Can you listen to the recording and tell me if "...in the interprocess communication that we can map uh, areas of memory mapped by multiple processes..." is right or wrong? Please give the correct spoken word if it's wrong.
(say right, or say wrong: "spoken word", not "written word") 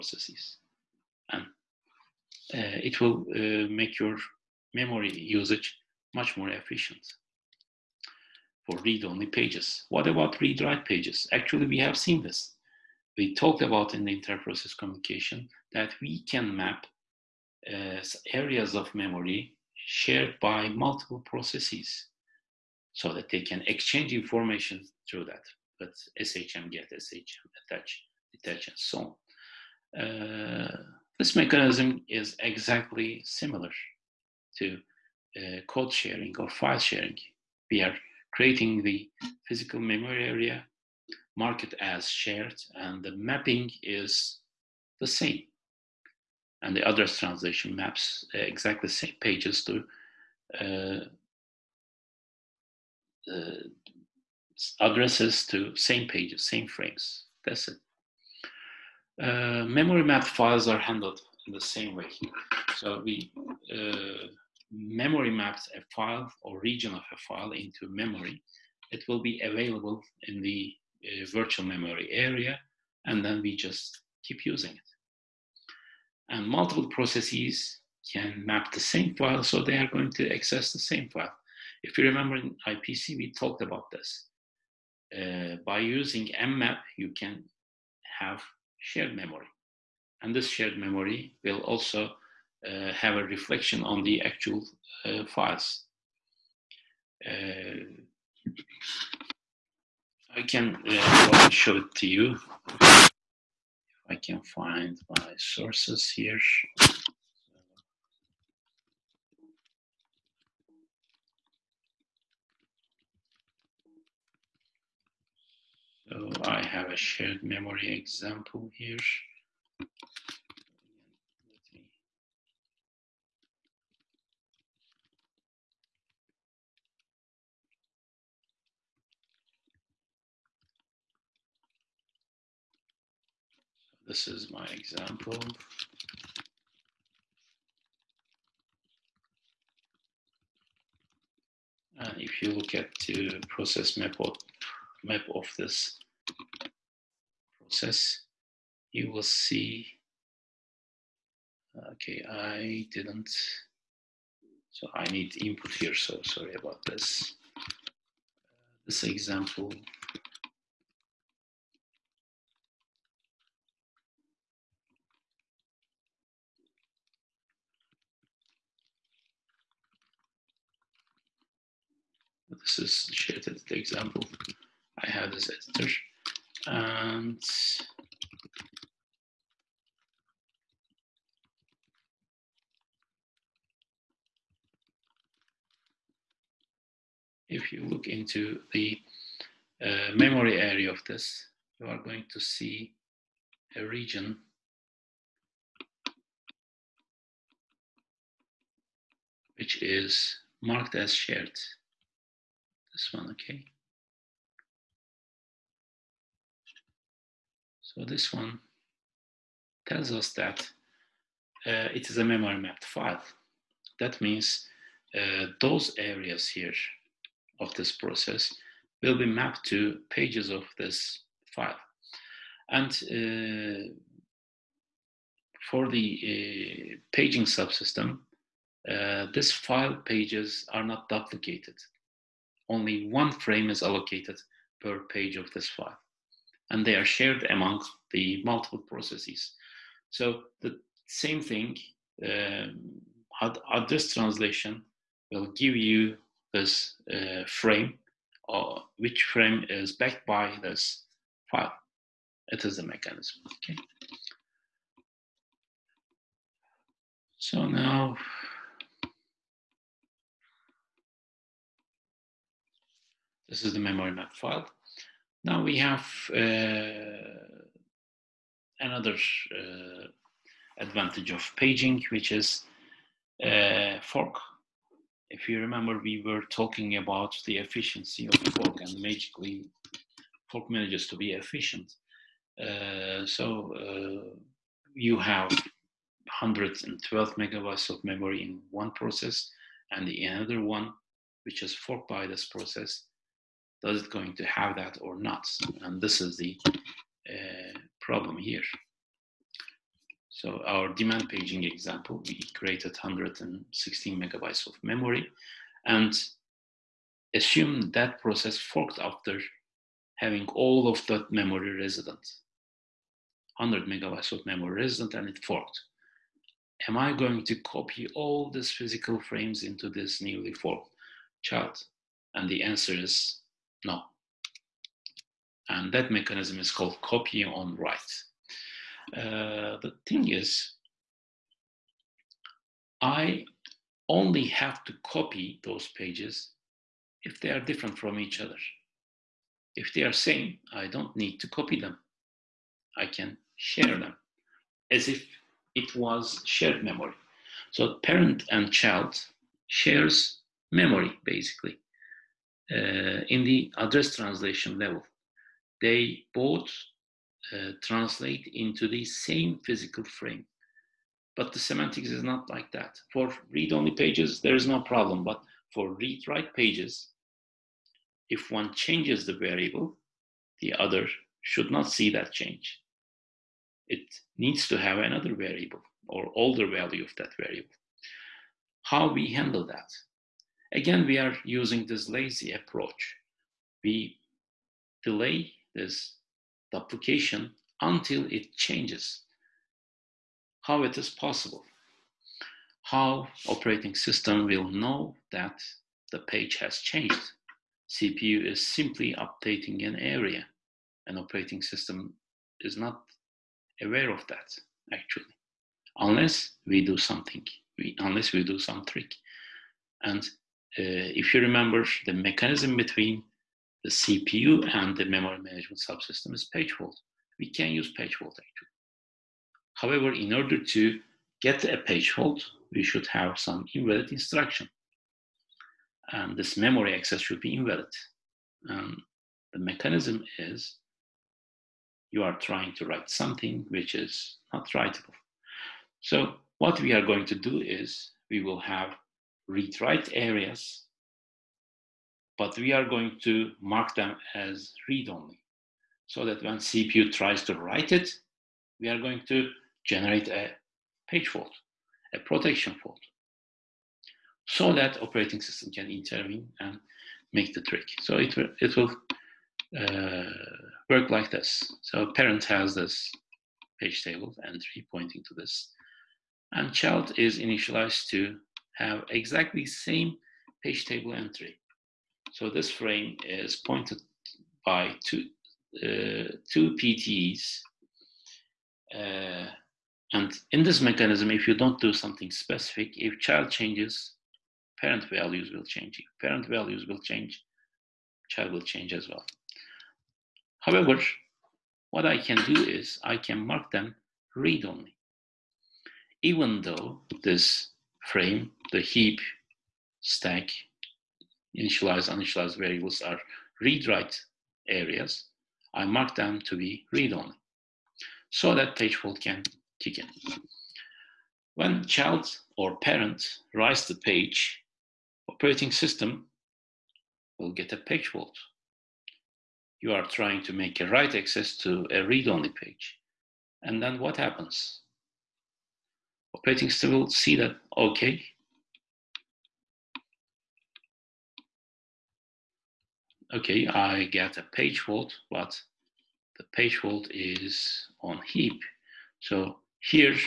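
wrong: "shared", not "mapped".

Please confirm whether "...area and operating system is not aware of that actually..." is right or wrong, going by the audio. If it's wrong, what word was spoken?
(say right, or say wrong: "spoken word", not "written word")
right.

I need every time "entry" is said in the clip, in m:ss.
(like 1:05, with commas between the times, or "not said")
7:44, 7:51.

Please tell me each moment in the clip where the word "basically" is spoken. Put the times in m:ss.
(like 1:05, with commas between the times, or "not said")
5:51.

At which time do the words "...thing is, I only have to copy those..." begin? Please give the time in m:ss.
5:30.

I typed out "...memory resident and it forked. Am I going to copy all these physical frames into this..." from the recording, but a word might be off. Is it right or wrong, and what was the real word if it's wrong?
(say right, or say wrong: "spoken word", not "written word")
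right.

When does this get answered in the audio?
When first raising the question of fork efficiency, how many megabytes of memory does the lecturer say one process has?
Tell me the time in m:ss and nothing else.
4:45.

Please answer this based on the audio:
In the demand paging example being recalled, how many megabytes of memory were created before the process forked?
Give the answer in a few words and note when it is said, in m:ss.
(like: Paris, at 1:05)
116 megabytes, at 5:02.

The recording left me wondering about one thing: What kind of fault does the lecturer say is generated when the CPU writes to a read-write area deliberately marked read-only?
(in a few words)
protection fault.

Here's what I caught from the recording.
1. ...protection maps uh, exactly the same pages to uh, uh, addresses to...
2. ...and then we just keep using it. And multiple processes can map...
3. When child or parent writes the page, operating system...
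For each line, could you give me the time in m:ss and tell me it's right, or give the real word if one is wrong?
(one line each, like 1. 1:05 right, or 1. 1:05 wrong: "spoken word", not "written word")
1. 0:47 wrong: "translation", not "protection"
2. 1:13 right
3. 8:31 right.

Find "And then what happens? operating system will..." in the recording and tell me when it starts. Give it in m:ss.
8:43.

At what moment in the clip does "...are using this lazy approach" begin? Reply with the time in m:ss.
6:21.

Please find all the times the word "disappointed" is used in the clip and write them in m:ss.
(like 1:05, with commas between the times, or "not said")
not said.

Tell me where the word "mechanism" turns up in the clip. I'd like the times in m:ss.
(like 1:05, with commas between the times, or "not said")
0:31, 4:12, 5:26, 6:52, 7:09, 8:00.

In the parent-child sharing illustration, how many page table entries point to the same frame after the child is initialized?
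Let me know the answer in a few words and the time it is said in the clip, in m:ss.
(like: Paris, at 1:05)
2, at 7:56.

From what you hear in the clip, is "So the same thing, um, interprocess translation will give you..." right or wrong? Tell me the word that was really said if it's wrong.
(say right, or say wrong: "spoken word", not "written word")
wrong: "address", not "interprocess".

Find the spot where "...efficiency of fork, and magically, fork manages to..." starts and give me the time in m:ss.
4:37.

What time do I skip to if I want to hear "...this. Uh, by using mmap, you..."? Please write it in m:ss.
1:23.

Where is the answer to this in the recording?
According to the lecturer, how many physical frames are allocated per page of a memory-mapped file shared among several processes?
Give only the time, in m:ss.
3:53.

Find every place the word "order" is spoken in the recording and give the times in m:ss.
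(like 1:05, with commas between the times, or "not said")
7:00.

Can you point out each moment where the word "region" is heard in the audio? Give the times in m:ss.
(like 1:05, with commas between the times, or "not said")
1:06, 3:13.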